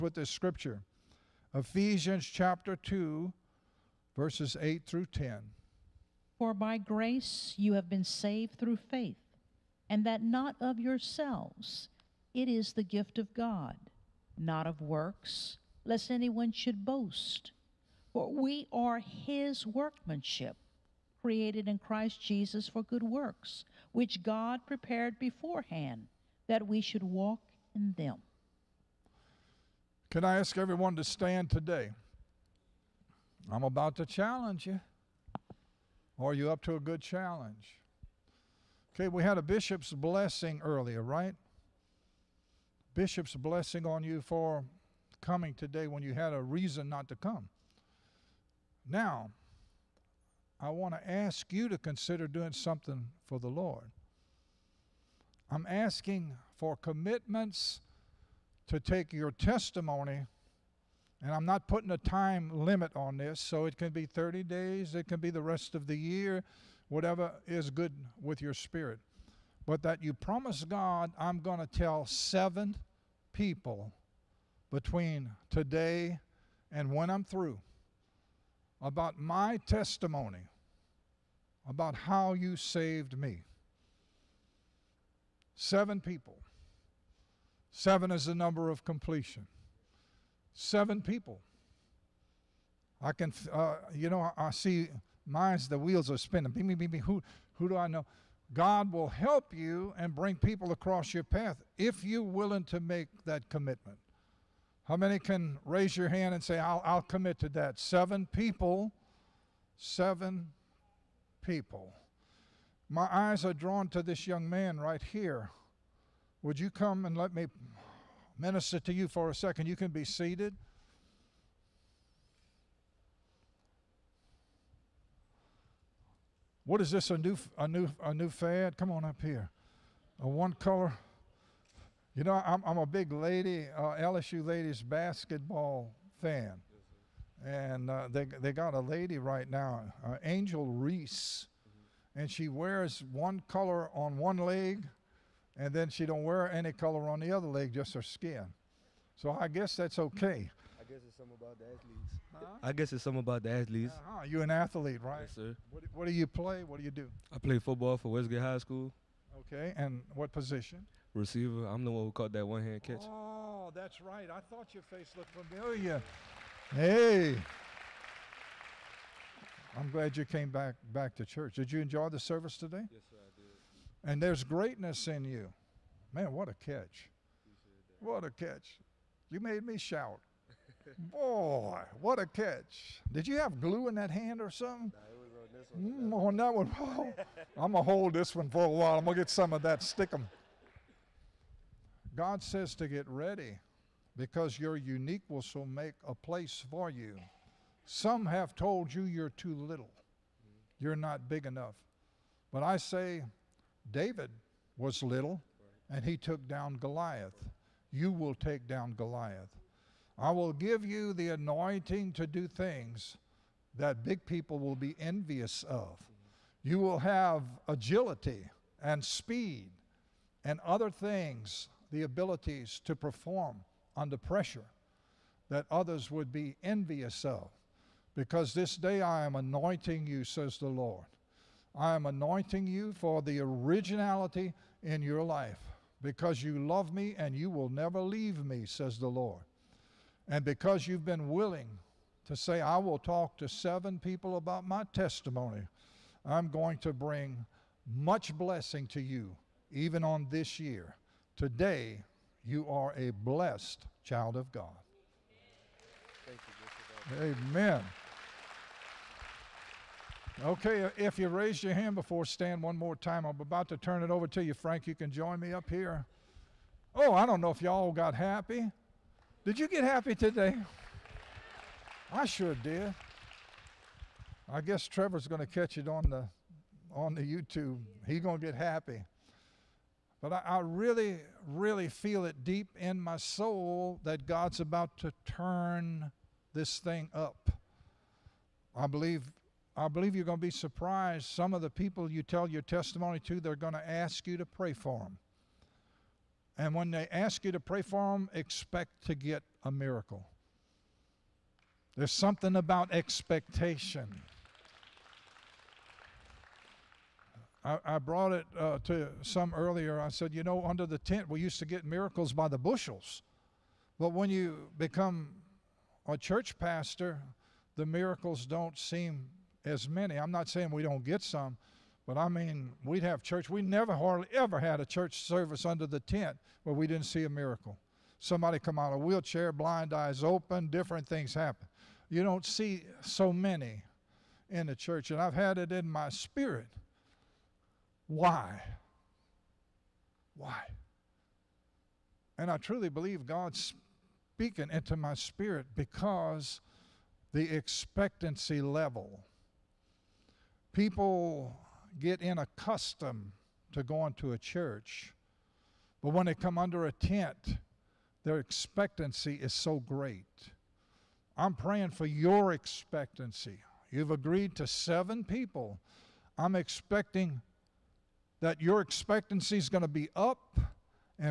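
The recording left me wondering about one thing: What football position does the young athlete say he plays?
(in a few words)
Receiver.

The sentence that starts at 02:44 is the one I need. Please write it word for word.
I thought your face looked familiar.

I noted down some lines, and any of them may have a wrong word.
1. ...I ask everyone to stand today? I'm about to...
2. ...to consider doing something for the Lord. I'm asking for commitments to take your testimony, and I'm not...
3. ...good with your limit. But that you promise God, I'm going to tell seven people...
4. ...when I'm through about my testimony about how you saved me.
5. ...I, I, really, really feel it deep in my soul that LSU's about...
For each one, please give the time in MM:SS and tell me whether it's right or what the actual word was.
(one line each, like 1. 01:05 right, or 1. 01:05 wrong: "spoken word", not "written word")
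1. 00:30 right
2. 00:51 right
3. 01:07 wrong: "spirit", not "limit"
4. 01:16 right
5. 04:40 wrong: "God", not "LSU".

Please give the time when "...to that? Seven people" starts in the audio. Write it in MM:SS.
01:47.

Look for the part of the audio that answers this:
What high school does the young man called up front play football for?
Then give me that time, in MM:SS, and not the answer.
02:38.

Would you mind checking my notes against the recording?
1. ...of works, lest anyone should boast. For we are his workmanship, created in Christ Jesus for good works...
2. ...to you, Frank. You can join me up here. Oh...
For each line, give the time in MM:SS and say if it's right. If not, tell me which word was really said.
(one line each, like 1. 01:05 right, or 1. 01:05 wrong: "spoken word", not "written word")
1. 00:14 right
2. 04:24 right.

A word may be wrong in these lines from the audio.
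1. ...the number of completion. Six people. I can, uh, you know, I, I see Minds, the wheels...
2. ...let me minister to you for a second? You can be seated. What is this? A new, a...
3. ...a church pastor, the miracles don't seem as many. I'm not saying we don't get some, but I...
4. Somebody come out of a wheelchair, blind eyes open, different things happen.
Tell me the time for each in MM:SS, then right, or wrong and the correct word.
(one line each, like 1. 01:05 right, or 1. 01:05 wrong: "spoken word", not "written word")
1. 01:28 wrong: "Seven", not "Six"
2. 01:57 right
3. 05:16 right
4. 05:28 right.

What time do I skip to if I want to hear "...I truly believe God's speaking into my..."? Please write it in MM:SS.
05:42.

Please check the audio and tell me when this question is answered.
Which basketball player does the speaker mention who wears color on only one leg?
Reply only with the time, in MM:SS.
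02:20.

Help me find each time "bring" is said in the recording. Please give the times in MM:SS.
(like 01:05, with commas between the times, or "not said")
01:40, 04:06.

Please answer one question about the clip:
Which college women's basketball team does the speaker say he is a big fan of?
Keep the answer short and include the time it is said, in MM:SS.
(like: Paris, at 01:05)
LSU, at 02:14.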